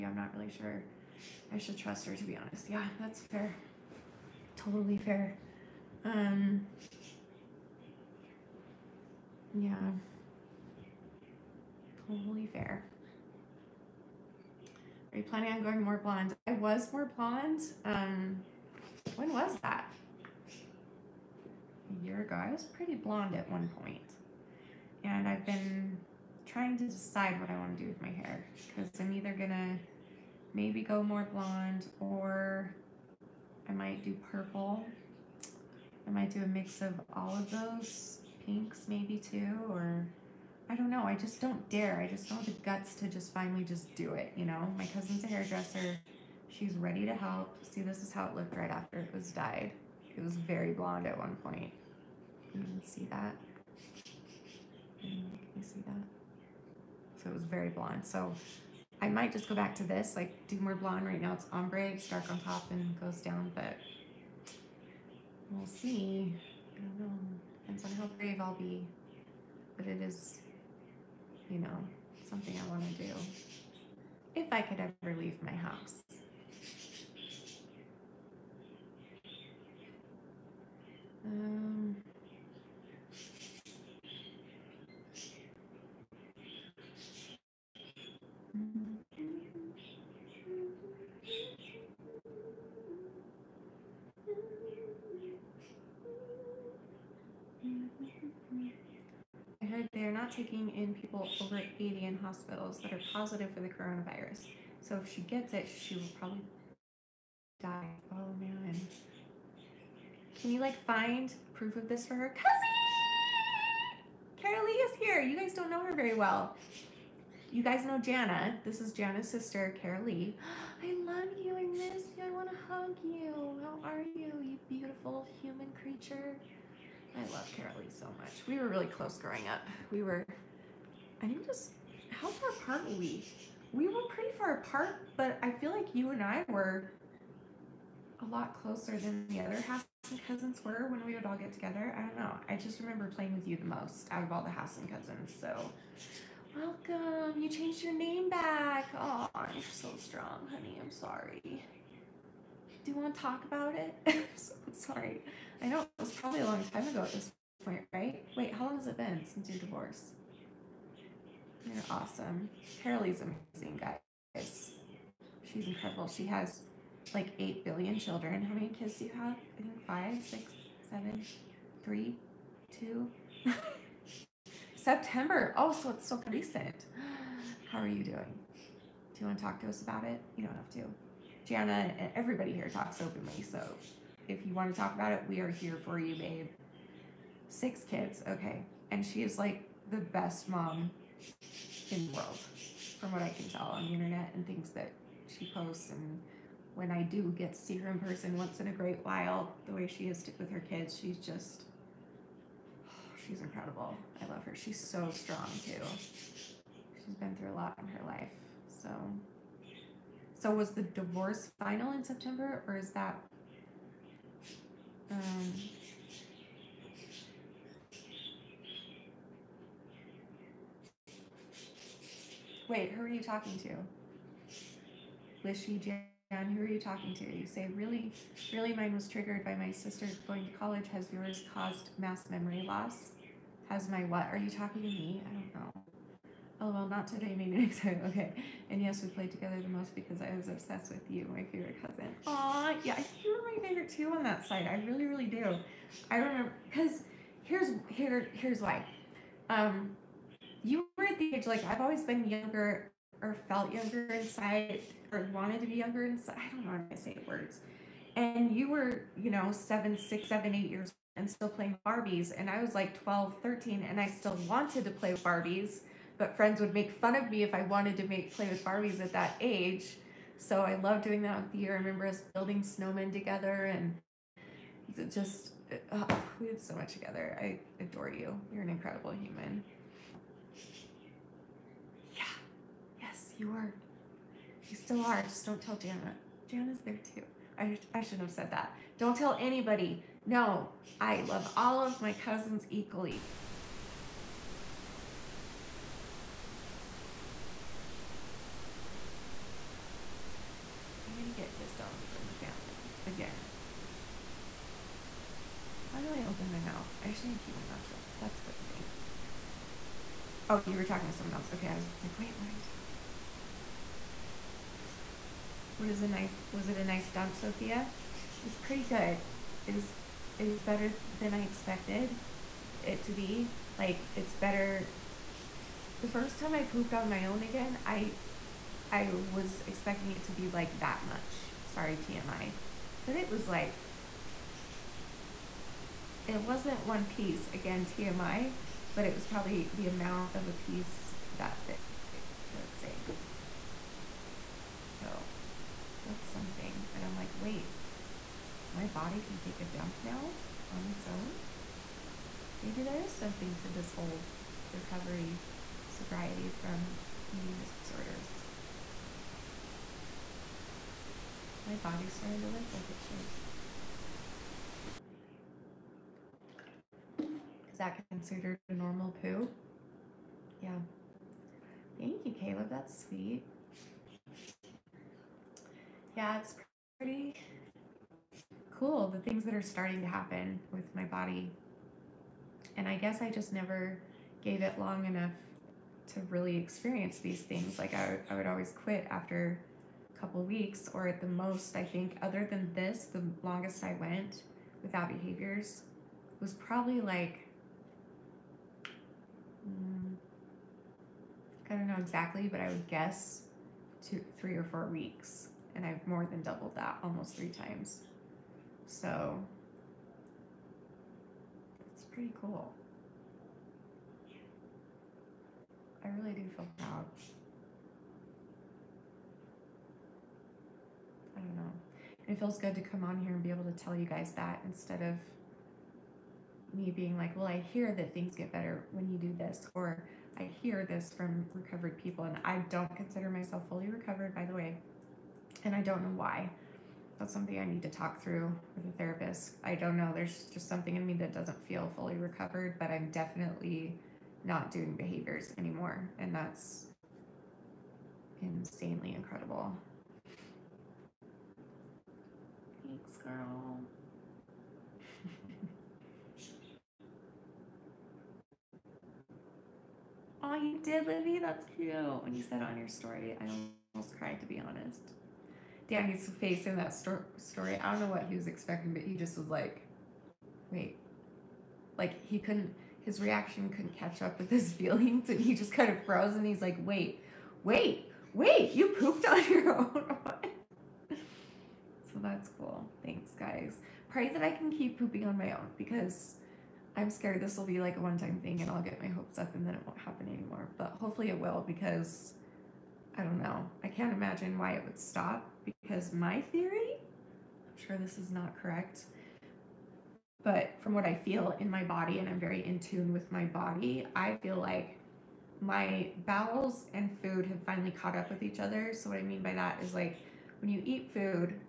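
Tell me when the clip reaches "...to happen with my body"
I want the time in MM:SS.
06:20.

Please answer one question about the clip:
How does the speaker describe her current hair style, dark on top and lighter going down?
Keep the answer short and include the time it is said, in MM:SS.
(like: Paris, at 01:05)
ombre, at 01:01.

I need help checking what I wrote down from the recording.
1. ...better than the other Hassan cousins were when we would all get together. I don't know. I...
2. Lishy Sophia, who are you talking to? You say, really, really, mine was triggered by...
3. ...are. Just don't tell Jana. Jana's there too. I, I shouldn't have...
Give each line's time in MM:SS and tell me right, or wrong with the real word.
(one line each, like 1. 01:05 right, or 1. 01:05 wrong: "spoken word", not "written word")
1. 02:18 wrong: "closer", not "better"
2. 03:45 wrong: "Jan", not "Sophia"
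3. 04:45 right.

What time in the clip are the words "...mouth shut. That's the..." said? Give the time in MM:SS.
05:07.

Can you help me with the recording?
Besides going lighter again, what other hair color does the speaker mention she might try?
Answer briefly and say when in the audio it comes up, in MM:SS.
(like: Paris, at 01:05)
purple, at 00:34.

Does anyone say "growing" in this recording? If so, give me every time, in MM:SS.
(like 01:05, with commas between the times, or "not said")
02:09.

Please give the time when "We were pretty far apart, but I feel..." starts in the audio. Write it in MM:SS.
02:13.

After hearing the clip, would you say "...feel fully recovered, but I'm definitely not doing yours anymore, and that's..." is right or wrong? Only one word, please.
wrong.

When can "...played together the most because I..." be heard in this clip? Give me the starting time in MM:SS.
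03:59.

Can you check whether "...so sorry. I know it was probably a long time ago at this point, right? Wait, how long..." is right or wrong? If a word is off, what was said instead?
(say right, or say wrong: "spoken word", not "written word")
right.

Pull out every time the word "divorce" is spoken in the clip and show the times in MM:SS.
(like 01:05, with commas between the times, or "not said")
02:39, 03:30.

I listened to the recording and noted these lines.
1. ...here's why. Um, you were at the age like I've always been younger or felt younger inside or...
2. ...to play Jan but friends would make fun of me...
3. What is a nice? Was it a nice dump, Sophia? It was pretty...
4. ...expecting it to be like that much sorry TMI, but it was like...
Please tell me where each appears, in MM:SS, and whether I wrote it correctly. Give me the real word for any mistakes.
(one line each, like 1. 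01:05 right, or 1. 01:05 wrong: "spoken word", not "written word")
1. 04:08 right
2. 04:24 wrong: "Barbies", not "Jan"
3. 05:15 right
4. 05:29 right.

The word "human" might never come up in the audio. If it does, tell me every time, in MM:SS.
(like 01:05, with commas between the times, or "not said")
02:05, 04:39.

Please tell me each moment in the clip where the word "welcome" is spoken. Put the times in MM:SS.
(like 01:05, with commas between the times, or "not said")
02:26.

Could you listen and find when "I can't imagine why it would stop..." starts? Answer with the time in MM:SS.
08:13.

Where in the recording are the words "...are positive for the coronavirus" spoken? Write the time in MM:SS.
01:42.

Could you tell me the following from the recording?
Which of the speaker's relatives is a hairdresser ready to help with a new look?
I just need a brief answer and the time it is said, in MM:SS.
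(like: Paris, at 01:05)
her cousin, at 00:44.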